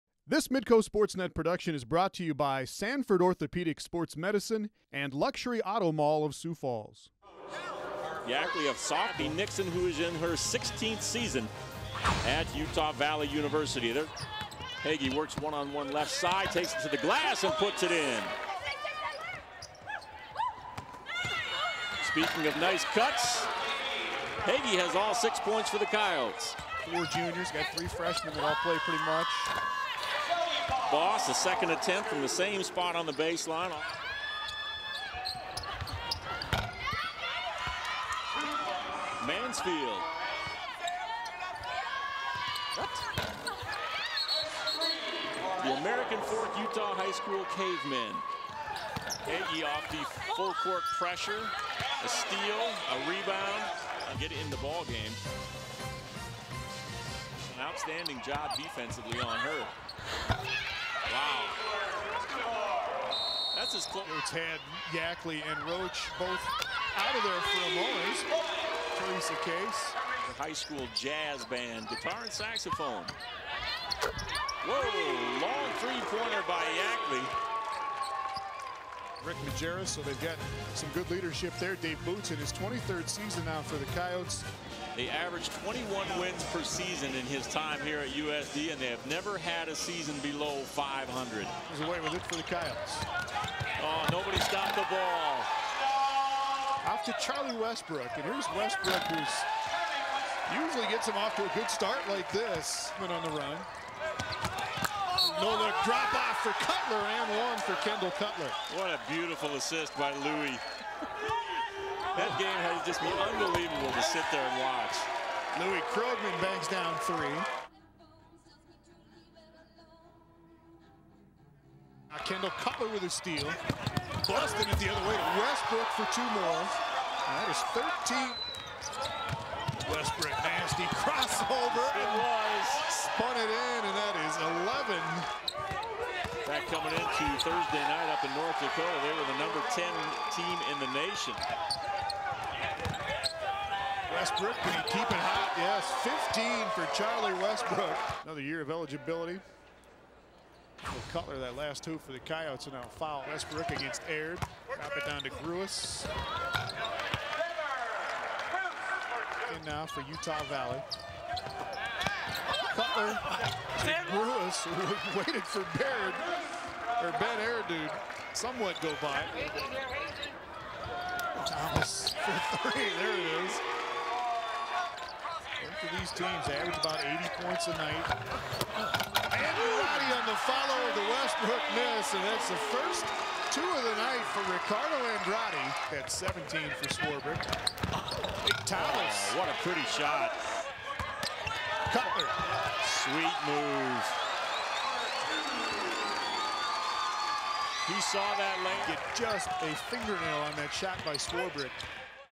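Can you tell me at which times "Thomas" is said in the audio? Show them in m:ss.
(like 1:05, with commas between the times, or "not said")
2:51, 3:08.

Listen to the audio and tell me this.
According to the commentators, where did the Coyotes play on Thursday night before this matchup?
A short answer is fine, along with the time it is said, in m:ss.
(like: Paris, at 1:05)
North Dakota, at 2:18.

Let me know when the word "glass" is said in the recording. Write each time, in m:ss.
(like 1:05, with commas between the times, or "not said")
0:17.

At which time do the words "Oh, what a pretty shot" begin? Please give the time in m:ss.
3:09.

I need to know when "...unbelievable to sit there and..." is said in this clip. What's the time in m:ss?
1:53.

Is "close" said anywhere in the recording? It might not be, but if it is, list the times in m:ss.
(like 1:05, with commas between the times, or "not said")
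1:03.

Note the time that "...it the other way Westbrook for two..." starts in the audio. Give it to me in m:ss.
2:04.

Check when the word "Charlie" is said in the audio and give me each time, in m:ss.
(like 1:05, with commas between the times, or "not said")
1:37, 2:26.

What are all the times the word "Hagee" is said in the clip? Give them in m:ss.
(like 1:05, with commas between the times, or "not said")
0:14, 0:24.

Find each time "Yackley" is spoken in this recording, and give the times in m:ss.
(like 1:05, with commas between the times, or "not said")
0:08, 1:04, 1:16.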